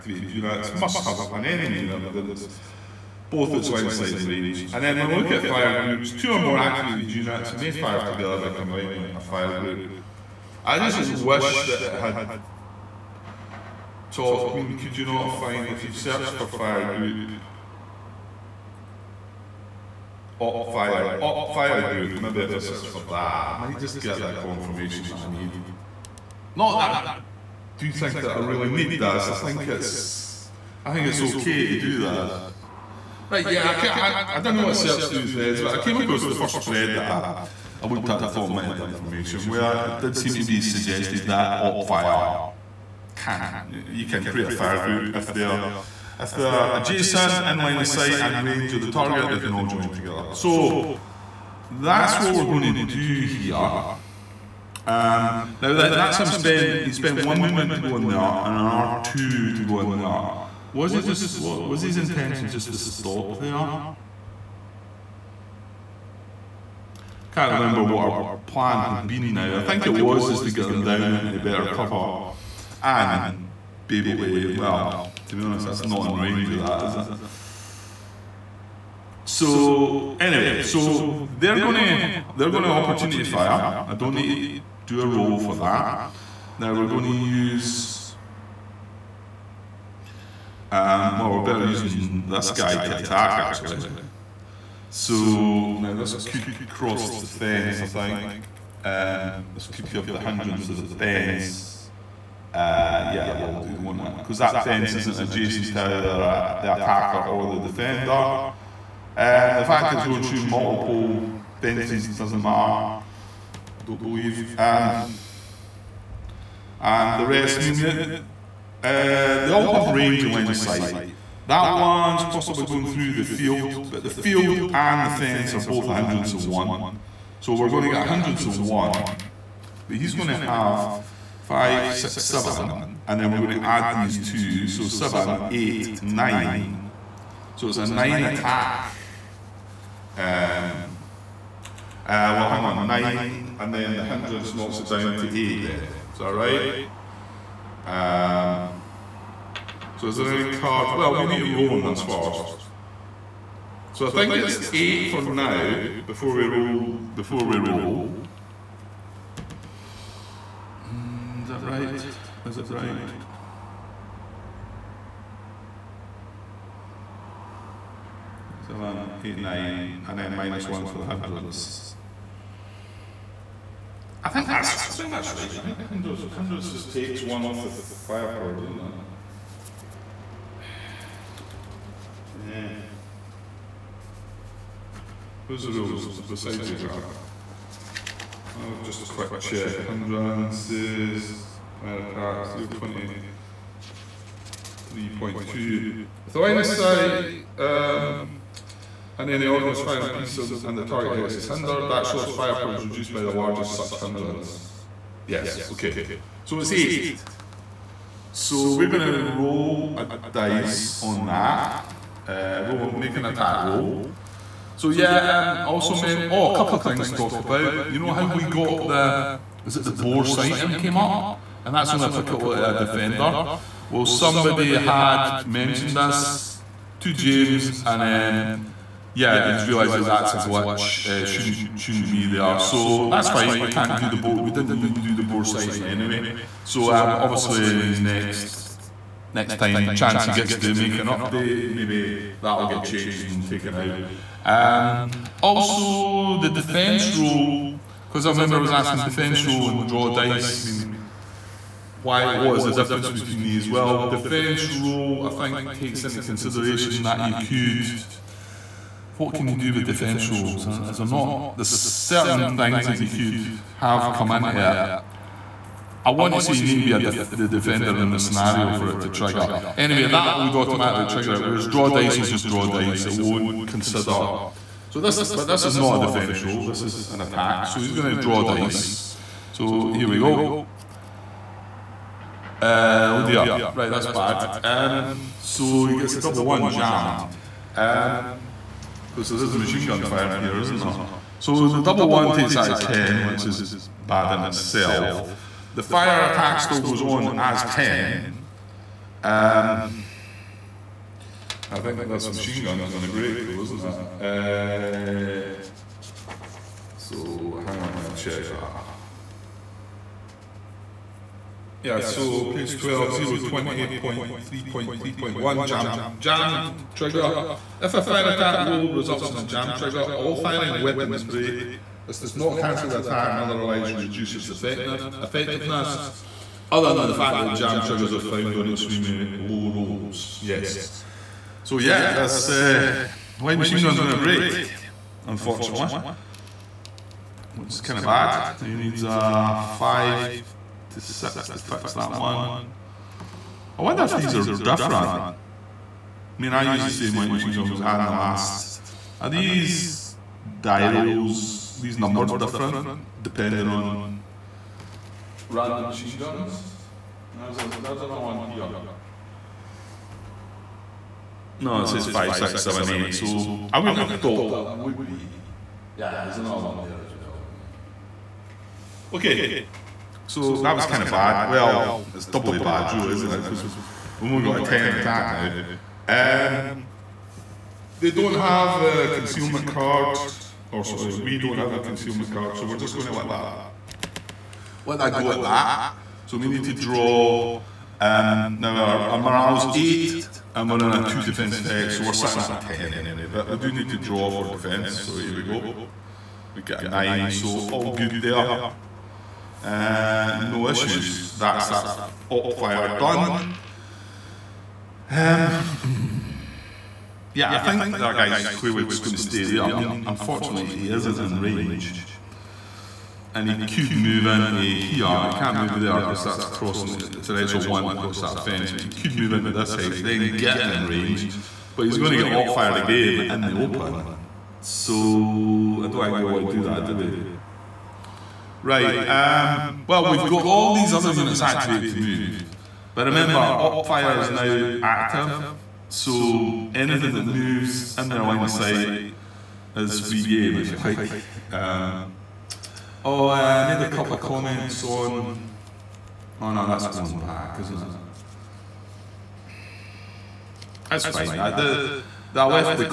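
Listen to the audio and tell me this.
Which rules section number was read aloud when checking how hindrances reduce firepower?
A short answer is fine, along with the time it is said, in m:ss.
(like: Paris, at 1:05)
023.2, at 3:12.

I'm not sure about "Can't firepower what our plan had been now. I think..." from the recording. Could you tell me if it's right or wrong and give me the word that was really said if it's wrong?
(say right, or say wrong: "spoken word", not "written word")
wrong: "remember", not "firepower".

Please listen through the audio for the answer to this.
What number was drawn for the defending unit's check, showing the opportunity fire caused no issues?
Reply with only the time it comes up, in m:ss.
6:36.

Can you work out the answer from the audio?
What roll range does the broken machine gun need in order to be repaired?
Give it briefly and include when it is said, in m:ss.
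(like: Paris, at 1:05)
5 to 6, at 5:39.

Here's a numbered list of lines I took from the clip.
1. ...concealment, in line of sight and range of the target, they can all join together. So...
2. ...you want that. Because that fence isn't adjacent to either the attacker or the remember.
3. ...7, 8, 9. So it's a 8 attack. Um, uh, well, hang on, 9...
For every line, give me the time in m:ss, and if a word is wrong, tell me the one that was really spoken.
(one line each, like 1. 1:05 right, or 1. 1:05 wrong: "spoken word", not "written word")
1. 0:46 wrong: "adjacent", not "concealment"
2. 1:43 wrong: "defender", not "remember"
3. 2:14 wrong: "9", not "8".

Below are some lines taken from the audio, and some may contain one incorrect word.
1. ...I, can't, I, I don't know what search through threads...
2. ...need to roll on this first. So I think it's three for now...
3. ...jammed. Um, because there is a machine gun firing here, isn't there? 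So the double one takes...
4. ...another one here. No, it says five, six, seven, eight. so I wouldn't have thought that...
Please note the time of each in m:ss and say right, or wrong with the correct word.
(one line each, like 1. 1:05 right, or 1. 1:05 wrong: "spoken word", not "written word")
1. 0:33 right
2. 2:31 wrong: "eight", not "three"
3. 4:46 right
4. 5:58 right.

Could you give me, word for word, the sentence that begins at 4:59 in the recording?
Um, I think this machine gun is going to break though, isn't it?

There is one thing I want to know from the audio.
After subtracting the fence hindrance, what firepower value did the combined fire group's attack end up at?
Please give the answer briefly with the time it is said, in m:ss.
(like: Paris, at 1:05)
8, at 3:26.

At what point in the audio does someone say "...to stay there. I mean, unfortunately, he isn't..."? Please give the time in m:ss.
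6:49.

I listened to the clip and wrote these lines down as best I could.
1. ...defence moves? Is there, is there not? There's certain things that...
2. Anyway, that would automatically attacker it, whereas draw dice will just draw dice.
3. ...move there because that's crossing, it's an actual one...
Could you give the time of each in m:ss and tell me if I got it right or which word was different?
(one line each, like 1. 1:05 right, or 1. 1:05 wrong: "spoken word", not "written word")
1. 4:19 wrong: "rules", not "moves"
2. 4:29 wrong: "trigger", not "attacker"
3. 6:55 right.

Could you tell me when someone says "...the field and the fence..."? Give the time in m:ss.
2:04.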